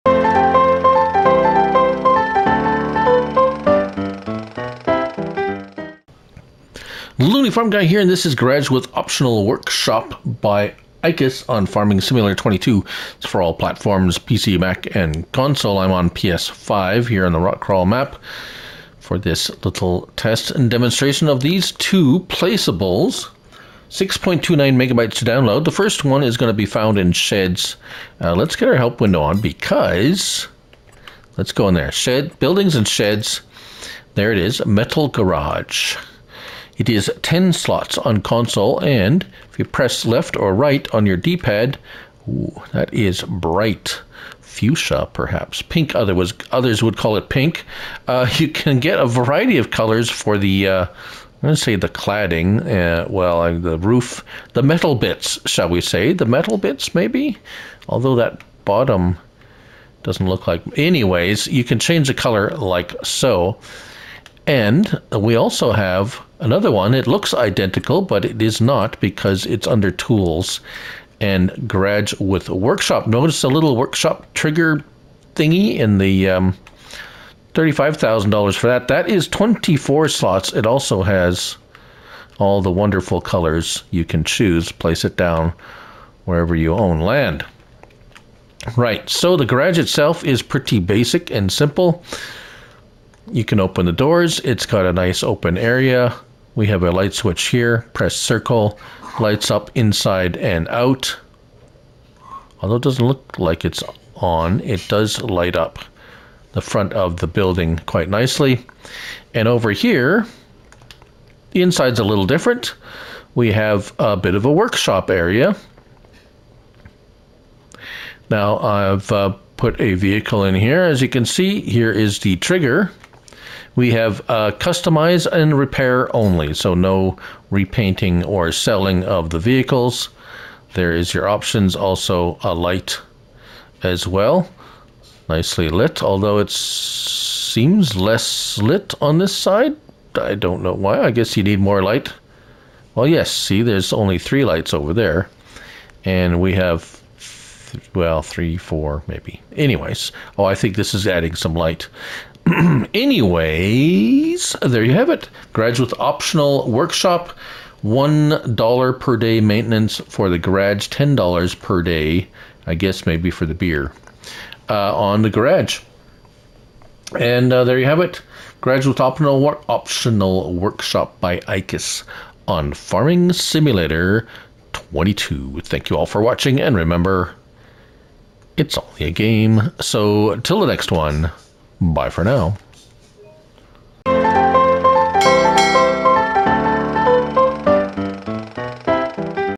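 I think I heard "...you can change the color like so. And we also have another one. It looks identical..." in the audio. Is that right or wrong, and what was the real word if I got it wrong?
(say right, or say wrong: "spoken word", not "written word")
right.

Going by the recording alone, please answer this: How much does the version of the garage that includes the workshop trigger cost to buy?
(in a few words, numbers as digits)
$35,000.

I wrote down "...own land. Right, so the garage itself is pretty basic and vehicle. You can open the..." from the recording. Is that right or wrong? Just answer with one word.
wrong.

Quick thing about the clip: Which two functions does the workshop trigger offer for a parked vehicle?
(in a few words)
Customize and repair.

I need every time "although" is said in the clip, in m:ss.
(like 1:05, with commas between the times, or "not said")
0:57, 1:42, 2:16.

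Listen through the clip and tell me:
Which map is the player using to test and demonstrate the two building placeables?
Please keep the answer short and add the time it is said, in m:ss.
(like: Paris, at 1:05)
Rock Crawl, at 0:17.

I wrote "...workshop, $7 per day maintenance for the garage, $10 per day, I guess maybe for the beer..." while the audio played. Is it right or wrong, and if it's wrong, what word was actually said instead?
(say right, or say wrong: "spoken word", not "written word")
wrong: "1", not "7".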